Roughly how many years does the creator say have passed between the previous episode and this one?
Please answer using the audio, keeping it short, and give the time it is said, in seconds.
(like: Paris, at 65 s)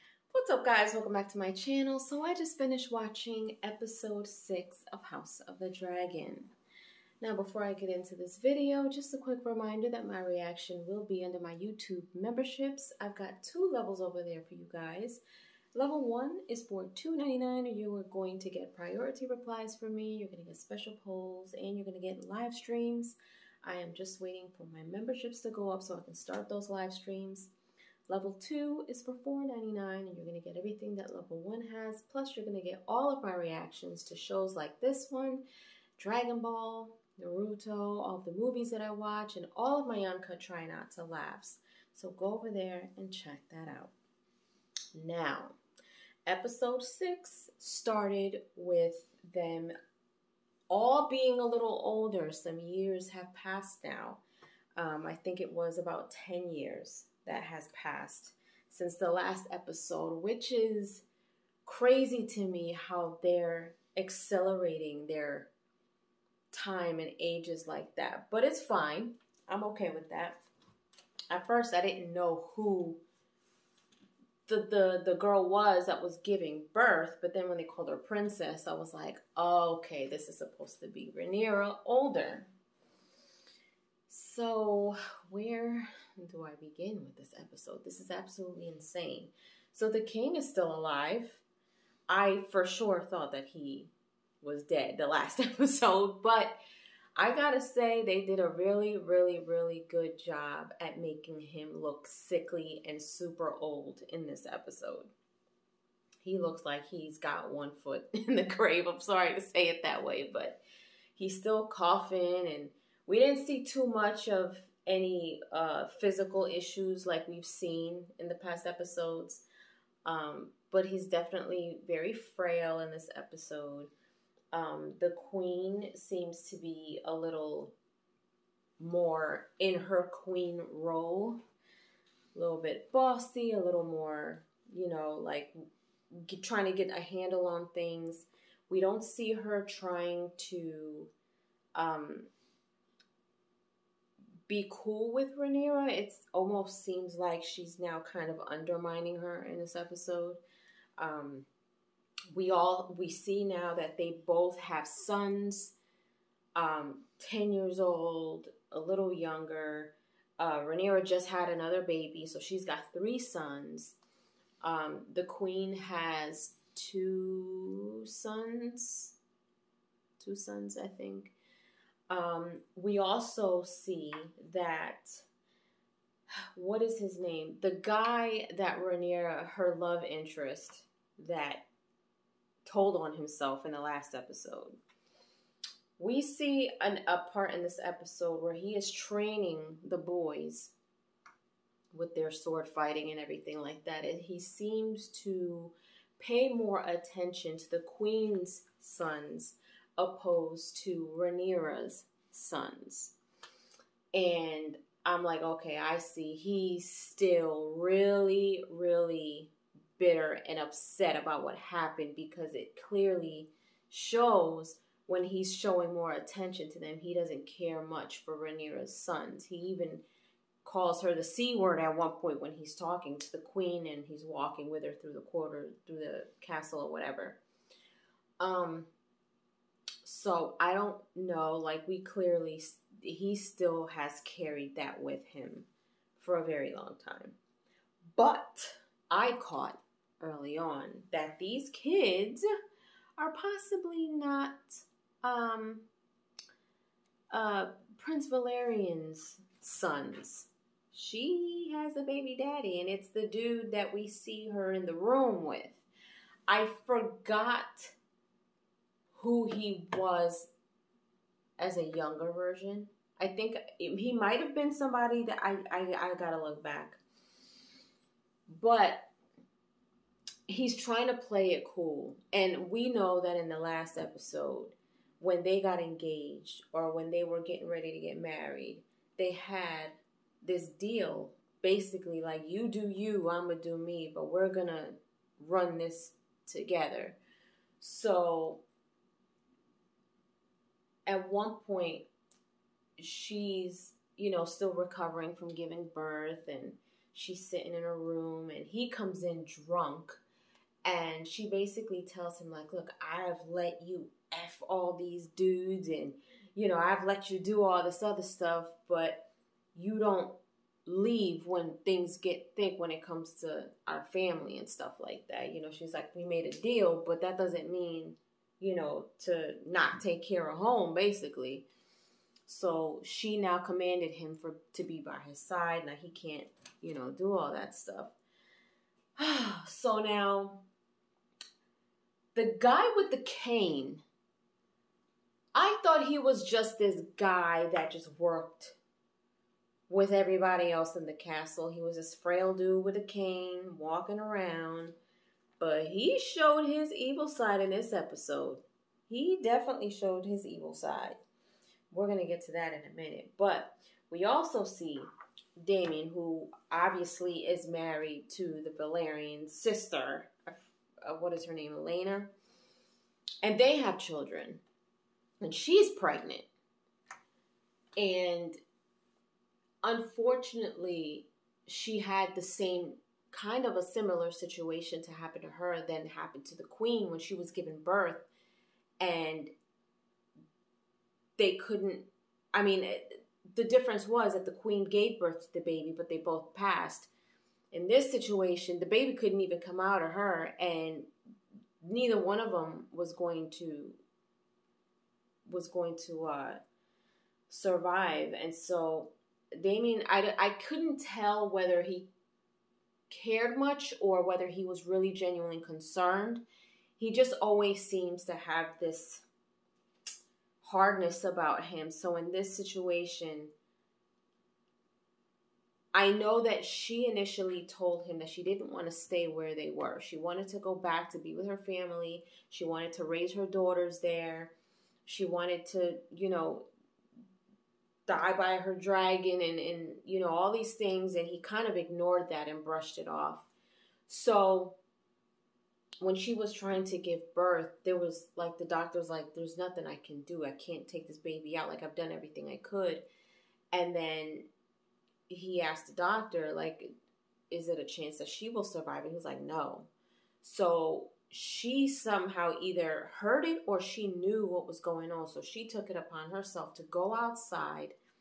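10, at 55 s.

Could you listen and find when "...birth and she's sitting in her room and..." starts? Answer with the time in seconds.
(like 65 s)
295 s.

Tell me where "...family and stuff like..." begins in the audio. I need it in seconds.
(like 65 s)
314 s.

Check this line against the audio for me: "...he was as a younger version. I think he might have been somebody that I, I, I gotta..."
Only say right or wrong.
right.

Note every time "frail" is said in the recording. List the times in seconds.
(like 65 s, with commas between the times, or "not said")
122 s, 342 s.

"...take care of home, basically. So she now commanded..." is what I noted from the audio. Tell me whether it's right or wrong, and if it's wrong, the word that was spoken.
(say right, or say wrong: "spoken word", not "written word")
right.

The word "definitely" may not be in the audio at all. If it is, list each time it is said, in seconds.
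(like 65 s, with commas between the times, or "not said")
121 s, 349 s.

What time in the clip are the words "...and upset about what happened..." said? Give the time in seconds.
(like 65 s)
210 s.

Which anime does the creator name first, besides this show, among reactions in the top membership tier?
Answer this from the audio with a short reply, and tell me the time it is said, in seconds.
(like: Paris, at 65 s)
Dragon Ball, at 35 s.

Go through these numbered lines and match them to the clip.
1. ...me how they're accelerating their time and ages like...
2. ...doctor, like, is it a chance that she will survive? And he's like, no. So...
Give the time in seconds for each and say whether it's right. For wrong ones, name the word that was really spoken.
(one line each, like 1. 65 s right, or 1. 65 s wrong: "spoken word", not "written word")
1. 62 s right
2. 445 s right.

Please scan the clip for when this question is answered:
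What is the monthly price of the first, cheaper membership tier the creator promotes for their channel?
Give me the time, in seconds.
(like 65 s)
16 s.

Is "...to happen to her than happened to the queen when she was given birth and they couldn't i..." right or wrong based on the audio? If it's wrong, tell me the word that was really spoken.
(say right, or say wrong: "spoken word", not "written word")
right.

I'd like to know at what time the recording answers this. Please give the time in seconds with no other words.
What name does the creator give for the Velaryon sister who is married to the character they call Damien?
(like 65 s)
361 s.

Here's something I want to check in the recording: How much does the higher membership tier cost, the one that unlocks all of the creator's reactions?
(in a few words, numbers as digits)
$4.99.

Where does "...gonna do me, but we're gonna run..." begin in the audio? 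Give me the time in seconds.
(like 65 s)
283 s.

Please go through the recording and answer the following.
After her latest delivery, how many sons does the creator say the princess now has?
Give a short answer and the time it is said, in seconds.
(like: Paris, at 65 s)
3, at 162 s.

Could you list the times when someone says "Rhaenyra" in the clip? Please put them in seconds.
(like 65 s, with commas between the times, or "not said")
81 s, 145 s, 160 s, 178 s, 201 s, 218 s.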